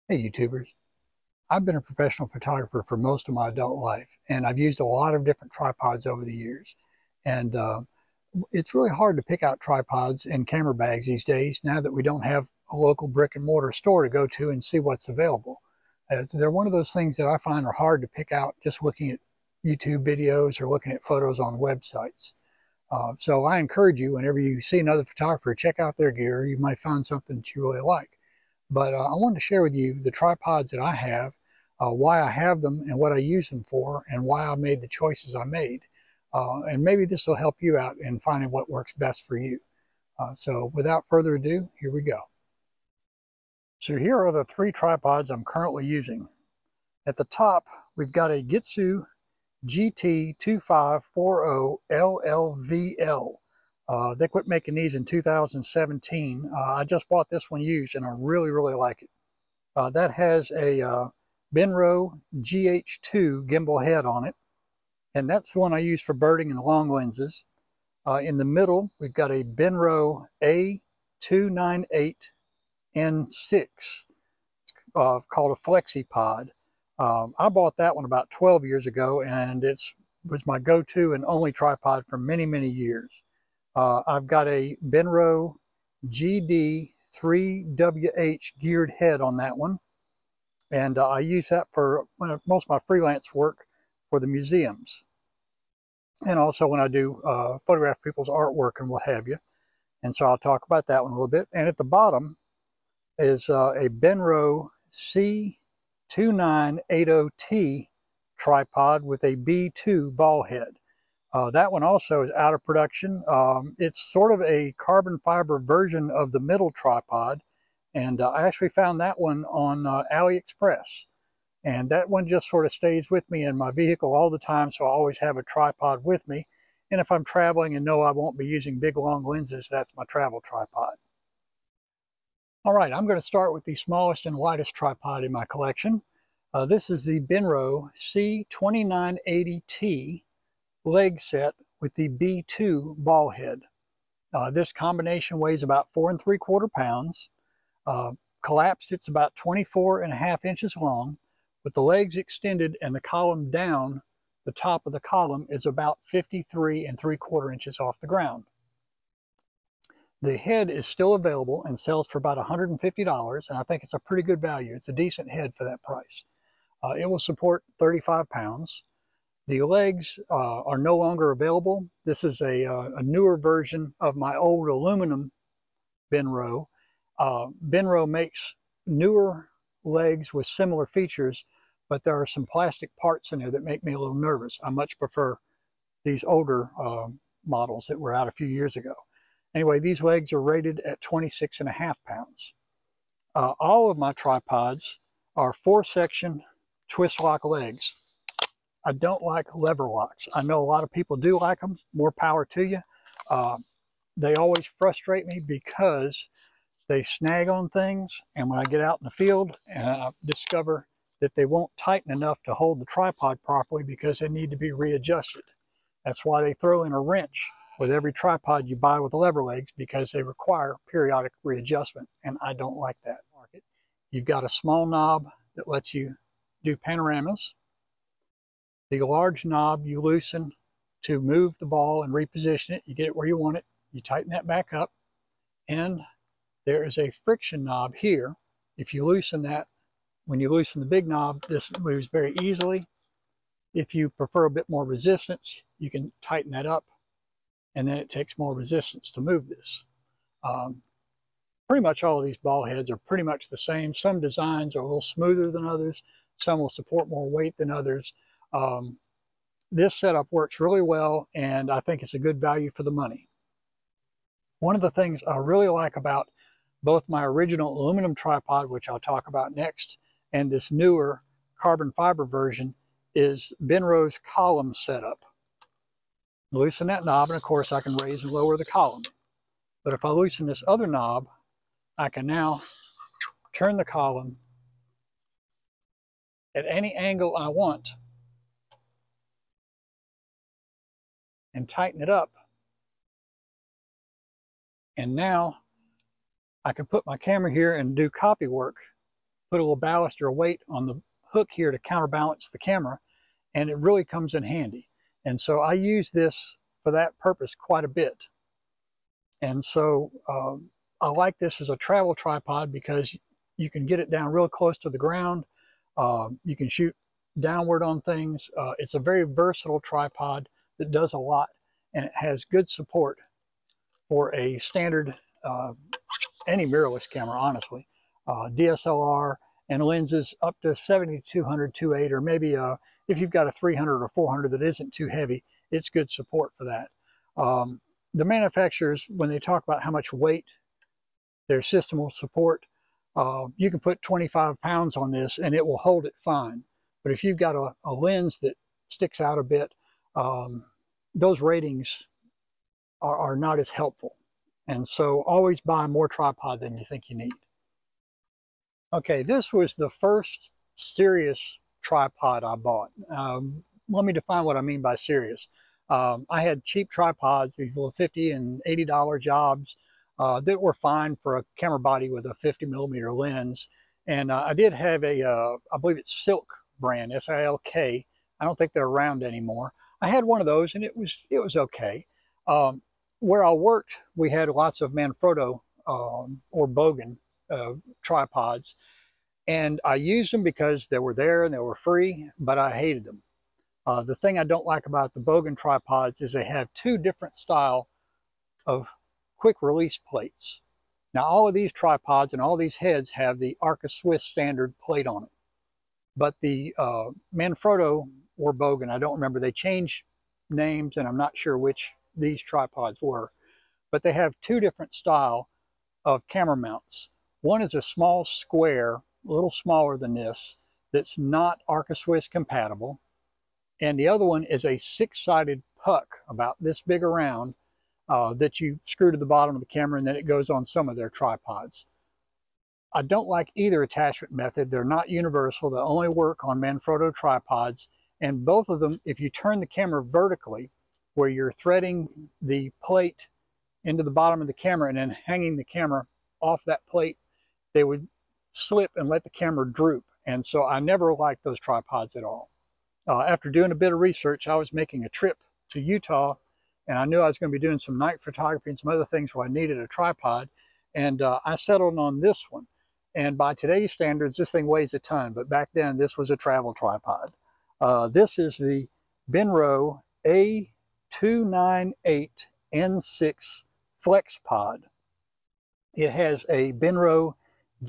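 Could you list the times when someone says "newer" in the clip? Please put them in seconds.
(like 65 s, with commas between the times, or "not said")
173 s, 178 s, 270 s.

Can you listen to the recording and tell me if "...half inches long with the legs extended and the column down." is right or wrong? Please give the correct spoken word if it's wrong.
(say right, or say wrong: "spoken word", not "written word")
right.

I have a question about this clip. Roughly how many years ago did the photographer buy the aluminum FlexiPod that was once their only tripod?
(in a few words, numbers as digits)
12.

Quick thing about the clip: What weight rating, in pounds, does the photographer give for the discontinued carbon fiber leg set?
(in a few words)
26.5.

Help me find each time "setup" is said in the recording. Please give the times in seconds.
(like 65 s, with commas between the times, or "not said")
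259 s, 274 s.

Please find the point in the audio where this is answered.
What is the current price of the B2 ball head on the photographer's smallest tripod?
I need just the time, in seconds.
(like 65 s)
162 s.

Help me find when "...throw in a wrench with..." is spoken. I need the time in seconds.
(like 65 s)
216 s.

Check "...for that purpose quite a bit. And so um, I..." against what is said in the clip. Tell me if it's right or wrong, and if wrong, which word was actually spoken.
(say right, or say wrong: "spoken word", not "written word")
right.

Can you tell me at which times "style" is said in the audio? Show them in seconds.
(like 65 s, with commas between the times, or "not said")
397 s, 414 s.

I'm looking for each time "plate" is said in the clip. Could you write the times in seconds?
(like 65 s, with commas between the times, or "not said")
399 s, 404 s, 442 s, 446 s.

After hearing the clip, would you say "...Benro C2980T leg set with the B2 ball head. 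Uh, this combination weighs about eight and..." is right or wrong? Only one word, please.
wrong.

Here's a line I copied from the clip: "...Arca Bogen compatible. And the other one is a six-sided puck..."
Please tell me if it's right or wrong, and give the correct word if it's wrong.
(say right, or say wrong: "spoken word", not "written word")
wrong: "Swiss", not "Bogen".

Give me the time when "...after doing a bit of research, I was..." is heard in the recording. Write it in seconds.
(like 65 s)
453 s.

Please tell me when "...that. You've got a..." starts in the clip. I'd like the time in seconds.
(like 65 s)
223 s.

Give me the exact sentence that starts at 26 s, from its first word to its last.
You might find something that you really like.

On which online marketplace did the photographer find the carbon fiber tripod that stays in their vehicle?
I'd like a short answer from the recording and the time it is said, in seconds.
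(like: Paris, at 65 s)
AliExpress, at 120 s.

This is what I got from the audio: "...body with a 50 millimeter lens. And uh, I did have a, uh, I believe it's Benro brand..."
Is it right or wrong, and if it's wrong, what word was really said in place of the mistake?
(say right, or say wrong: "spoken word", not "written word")
wrong: "Silk", not "Benro".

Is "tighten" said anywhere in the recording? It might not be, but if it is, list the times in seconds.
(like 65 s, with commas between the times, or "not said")
211 s, 234 s, 246 s, 291 s.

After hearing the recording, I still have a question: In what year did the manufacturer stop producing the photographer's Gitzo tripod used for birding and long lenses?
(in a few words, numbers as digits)
2017.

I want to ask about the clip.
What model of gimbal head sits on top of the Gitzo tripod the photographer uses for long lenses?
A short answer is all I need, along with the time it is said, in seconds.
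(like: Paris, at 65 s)
Benro GH2, at 61 s.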